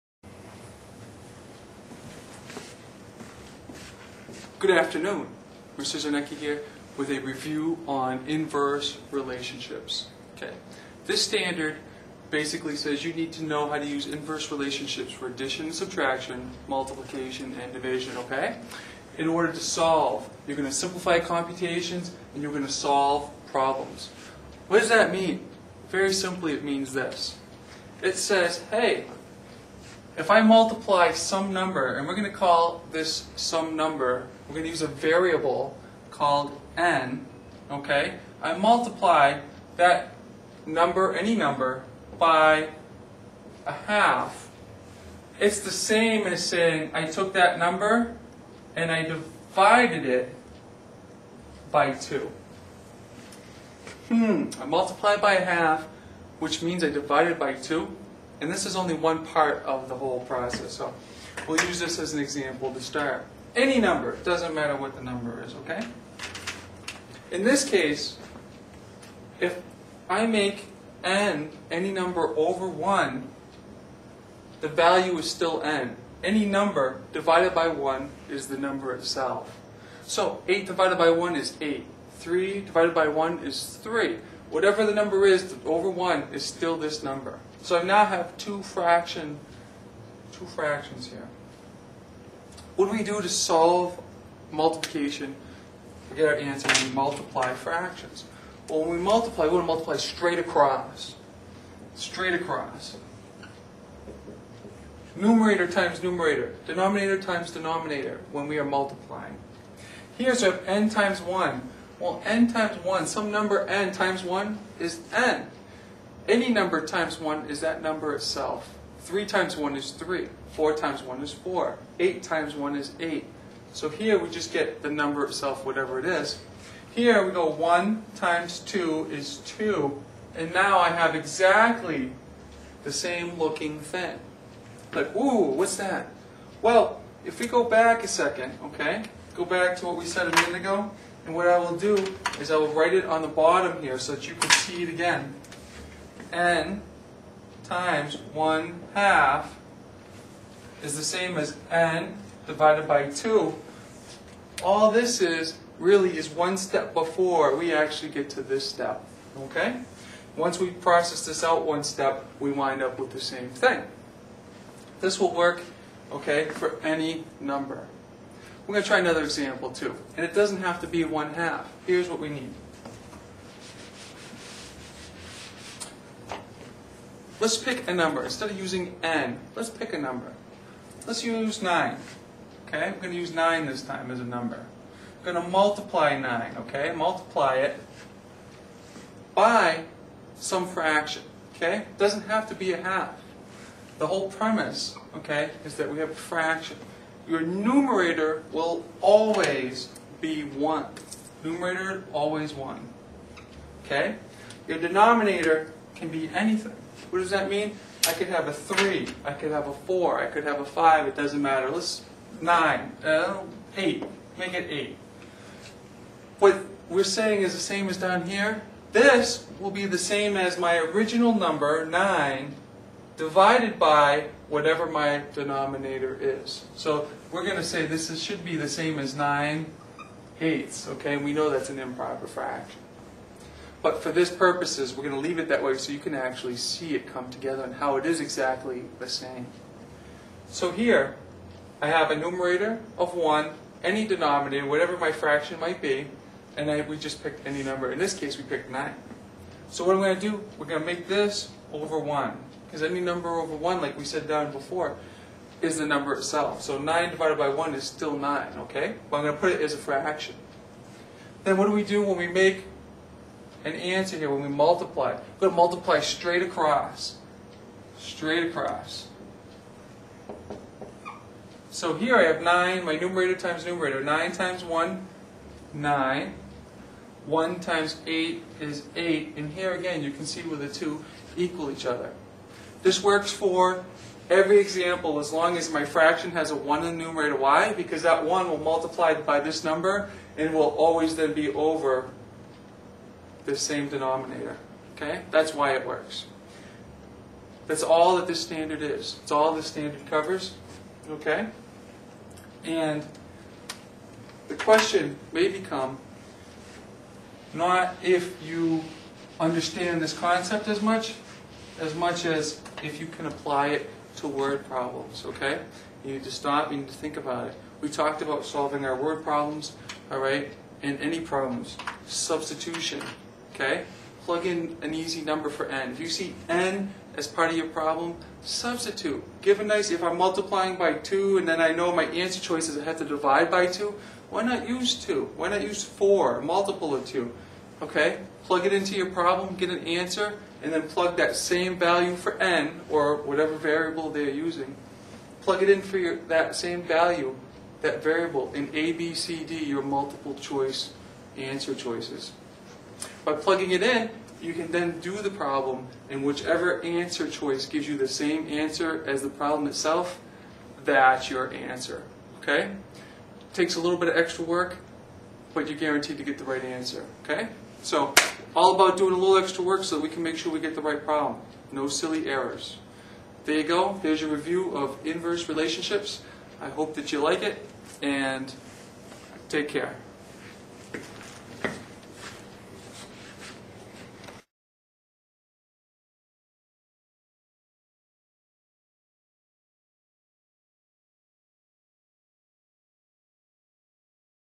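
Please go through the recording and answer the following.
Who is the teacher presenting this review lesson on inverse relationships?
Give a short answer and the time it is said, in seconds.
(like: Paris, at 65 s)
Mr. Czarnecki, at 5 s.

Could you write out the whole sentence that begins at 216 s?
What we're saying is the same as down here.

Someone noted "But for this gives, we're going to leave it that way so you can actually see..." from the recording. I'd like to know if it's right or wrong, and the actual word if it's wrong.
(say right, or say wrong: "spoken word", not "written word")
wrong: "purposes", not "gives".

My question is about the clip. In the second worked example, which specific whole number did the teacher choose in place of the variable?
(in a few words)
9.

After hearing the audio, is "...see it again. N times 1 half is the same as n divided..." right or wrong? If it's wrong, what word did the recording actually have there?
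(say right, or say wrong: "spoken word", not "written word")
right.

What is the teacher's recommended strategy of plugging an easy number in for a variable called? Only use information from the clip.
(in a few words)
Substitution.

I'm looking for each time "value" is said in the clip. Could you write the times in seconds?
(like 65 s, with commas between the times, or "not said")
74 s, 341 s, 346 s.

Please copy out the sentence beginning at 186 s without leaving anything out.
Multiply it by some fraction, okay?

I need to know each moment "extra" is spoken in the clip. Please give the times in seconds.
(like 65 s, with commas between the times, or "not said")
364 s, 369 s.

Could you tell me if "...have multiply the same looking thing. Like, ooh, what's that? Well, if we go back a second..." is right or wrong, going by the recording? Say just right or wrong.
wrong.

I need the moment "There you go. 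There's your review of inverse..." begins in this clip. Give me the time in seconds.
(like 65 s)
373 s.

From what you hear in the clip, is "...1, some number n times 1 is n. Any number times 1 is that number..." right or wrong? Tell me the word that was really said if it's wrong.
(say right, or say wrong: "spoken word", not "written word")
right.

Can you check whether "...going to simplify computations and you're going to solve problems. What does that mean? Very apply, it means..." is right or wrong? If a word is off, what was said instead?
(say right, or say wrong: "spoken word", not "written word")
wrong: "simply", not "apply".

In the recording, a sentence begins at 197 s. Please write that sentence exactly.
Your numerator will always be 1.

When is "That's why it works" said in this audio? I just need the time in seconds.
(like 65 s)
295 s.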